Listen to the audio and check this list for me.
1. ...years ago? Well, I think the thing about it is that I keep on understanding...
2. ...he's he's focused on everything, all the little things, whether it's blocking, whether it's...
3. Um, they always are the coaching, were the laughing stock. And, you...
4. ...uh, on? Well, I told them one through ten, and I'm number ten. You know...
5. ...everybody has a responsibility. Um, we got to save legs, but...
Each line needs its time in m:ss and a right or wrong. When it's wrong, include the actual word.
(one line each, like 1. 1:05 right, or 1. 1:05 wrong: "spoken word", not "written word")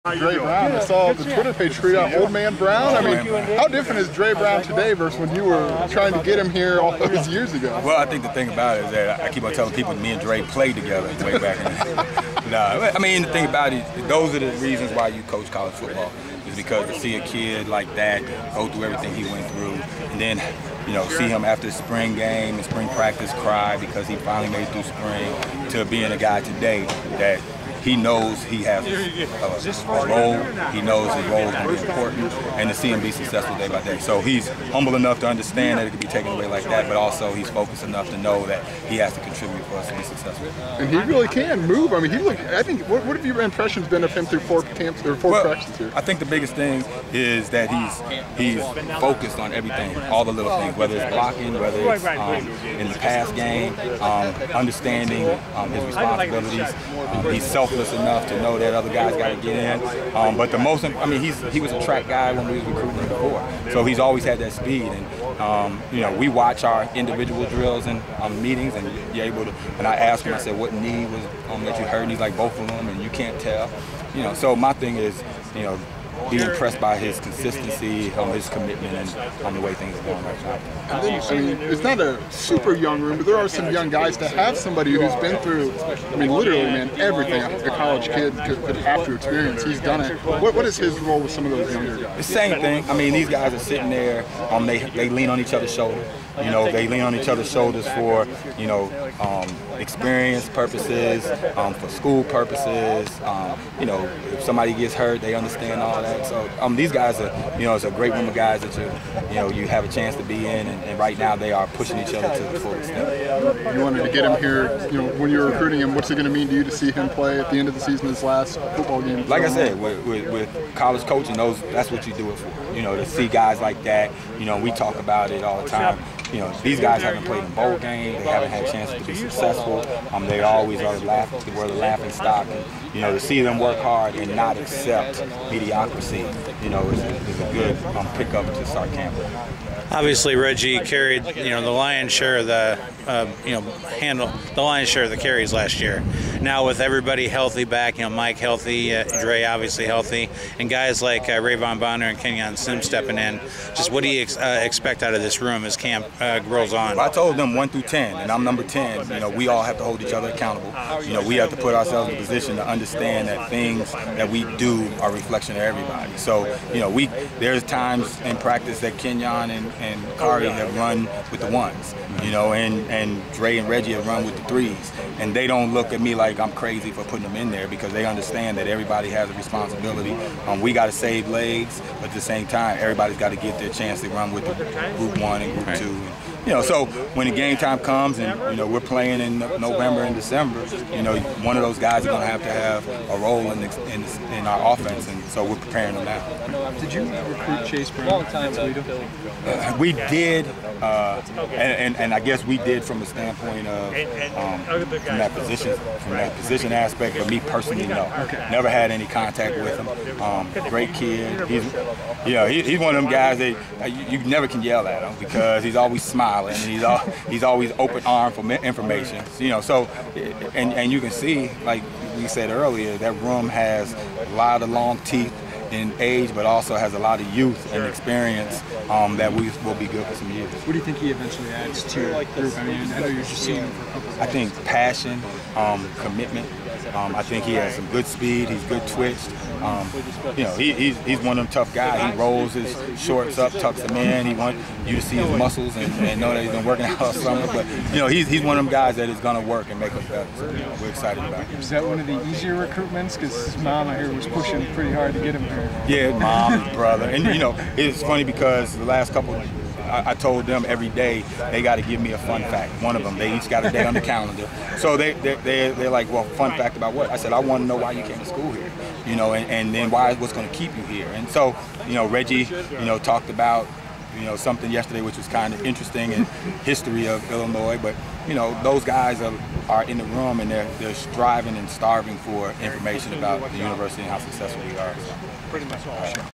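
1. 0:07 wrong: "telling", not "understanding"
2. 0:47 right
3. 2:10 wrong: "laughing", not "coaching"
4. 2:36 right
5. 2:58 right.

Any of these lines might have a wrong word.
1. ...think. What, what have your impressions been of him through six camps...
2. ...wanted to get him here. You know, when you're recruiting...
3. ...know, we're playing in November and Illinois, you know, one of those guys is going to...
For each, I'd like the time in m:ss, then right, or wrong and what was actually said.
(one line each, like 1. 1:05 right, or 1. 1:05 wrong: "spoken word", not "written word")
1. 0:42 wrong: "four", not "six"
2. 1:53 right
3. 3:08 wrong: "December", not "Illinois".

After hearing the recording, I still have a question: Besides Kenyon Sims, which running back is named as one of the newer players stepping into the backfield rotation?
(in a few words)
Ra'Von Bonner.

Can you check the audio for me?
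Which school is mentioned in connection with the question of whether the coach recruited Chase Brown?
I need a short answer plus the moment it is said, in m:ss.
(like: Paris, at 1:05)
Toledo, at 3:18.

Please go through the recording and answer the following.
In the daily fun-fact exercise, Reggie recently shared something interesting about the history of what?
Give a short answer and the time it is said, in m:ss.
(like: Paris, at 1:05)
Illinois, at 4:37.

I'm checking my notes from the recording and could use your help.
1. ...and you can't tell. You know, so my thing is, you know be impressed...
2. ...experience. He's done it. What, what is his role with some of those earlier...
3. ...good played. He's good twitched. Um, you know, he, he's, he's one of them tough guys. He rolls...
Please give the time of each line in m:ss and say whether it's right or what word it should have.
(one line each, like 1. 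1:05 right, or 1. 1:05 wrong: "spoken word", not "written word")
1. 1:12 right
2. 1:29 wrong: "younger", not "earlier"
3. 3:57 wrong: "speed", not "played".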